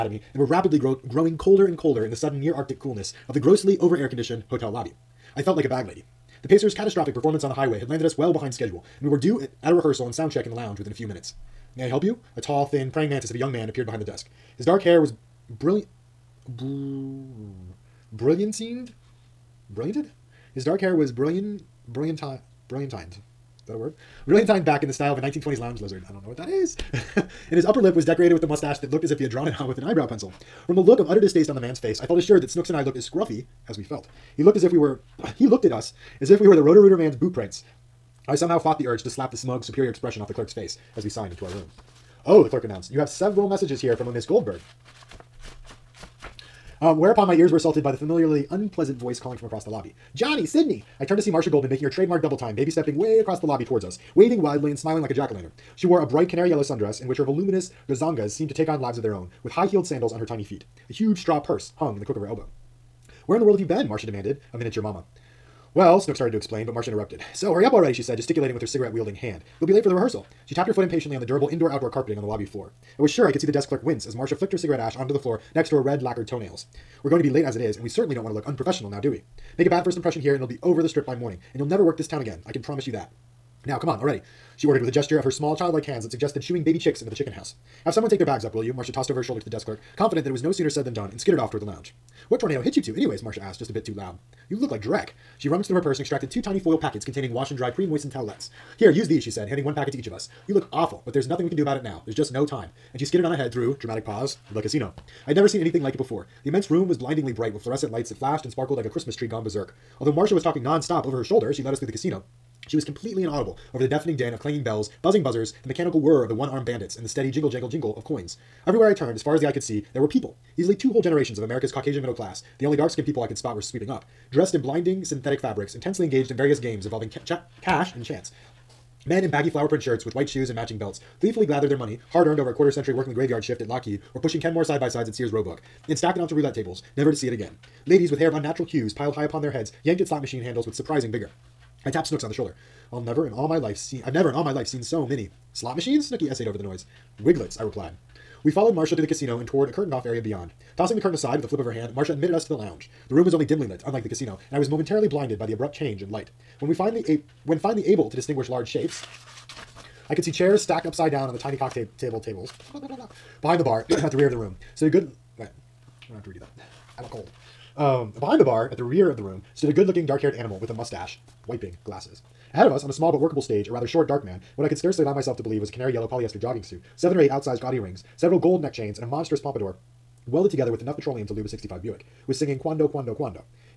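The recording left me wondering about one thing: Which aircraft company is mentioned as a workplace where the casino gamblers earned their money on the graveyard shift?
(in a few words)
Lockheed.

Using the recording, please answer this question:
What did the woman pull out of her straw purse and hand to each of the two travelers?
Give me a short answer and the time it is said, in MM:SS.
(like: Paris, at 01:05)
towelettes, at 01:38.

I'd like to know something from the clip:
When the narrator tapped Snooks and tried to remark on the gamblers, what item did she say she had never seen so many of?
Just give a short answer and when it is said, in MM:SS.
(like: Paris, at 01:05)
Wiglets, at 02:27.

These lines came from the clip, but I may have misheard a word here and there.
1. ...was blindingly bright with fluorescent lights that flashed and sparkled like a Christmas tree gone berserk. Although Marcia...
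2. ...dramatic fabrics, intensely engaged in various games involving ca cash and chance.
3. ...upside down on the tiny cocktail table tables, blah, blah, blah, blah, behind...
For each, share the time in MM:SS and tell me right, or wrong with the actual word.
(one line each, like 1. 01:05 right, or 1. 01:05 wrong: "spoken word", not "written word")
1. 01:46 right
2. 02:05 wrong: "synthetic", not "dramatic"
3. 02:40 right.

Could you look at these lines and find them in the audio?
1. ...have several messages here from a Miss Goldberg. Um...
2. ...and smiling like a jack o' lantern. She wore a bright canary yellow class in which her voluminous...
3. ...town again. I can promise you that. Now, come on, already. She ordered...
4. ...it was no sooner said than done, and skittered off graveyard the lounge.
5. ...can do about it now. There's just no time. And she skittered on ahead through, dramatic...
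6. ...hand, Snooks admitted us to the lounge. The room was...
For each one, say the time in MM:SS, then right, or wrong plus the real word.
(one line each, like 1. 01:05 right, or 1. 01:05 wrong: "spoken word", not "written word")
1. 00:42 right
2. 00:54 wrong: "sundress", not "class"
3. 01:22 right
4. 01:30 wrong: "toward", not "graveyard"
5. 01:41 right
6. 02:31 wrong: "Marcia", not "Snooks".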